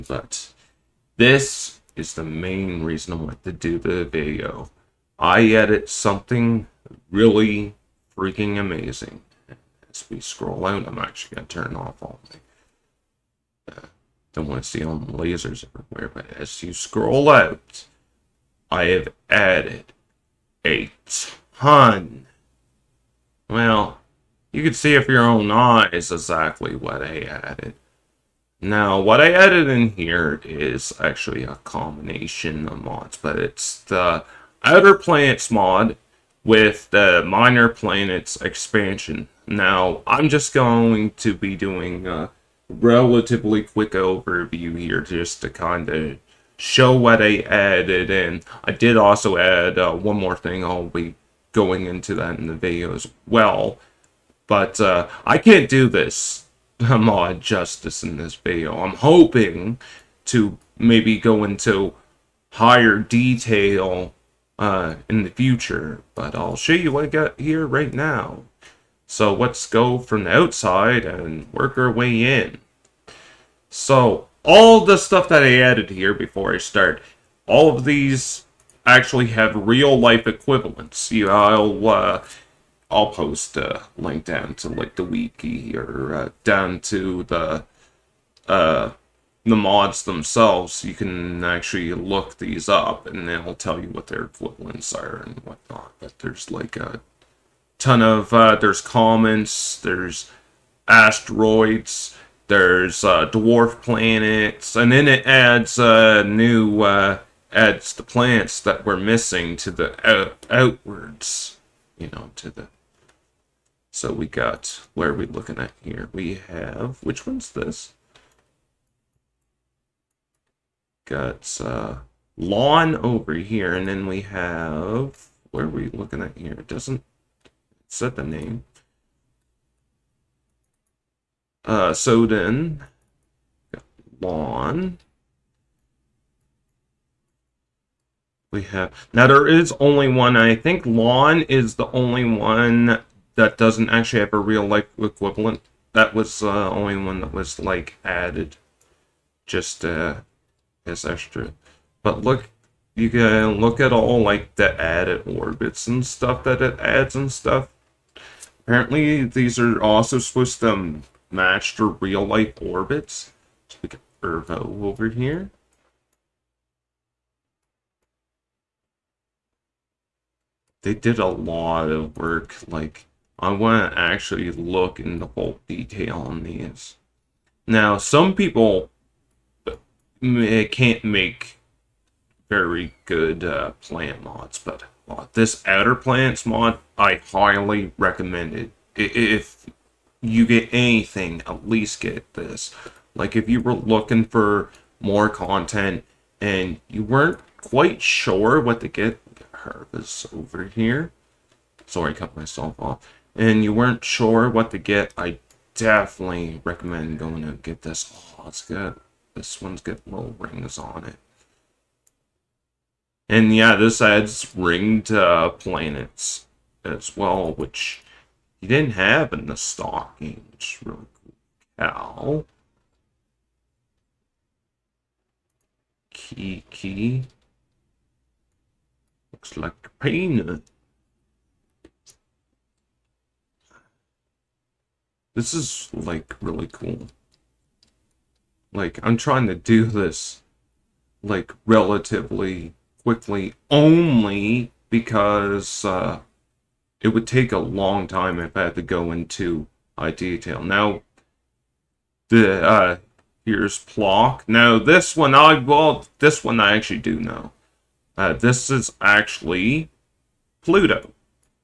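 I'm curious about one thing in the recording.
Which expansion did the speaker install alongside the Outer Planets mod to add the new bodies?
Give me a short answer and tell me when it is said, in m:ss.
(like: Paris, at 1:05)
Minor Planets, at 0:37.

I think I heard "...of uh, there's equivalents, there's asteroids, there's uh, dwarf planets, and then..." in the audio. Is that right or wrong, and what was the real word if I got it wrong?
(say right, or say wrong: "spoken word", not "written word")
wrong: "comets", not "equivalents".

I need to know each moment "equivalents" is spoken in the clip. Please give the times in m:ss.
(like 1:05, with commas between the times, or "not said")
1:20, 1:34, 2:24.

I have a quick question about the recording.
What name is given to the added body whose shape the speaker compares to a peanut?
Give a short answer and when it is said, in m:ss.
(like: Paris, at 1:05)
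Kiki, at 3:46.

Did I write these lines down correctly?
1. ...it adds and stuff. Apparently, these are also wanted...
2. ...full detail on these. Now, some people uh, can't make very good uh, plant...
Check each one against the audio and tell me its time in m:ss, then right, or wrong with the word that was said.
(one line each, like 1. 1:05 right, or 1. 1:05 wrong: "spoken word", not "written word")
1. 2:36 wrong: "supposed", not "wanted"
2. 2:55 right.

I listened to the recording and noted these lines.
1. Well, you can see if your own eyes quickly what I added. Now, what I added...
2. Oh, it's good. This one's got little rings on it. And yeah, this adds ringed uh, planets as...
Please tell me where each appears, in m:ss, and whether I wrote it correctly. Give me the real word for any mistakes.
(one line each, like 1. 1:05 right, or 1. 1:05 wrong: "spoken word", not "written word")
1. 0:23 wrong: "exactly", not "quickly"
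2. 3:28 right.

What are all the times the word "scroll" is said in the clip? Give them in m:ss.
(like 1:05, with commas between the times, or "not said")
0:10, 0:16.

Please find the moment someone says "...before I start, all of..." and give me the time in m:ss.
1:16.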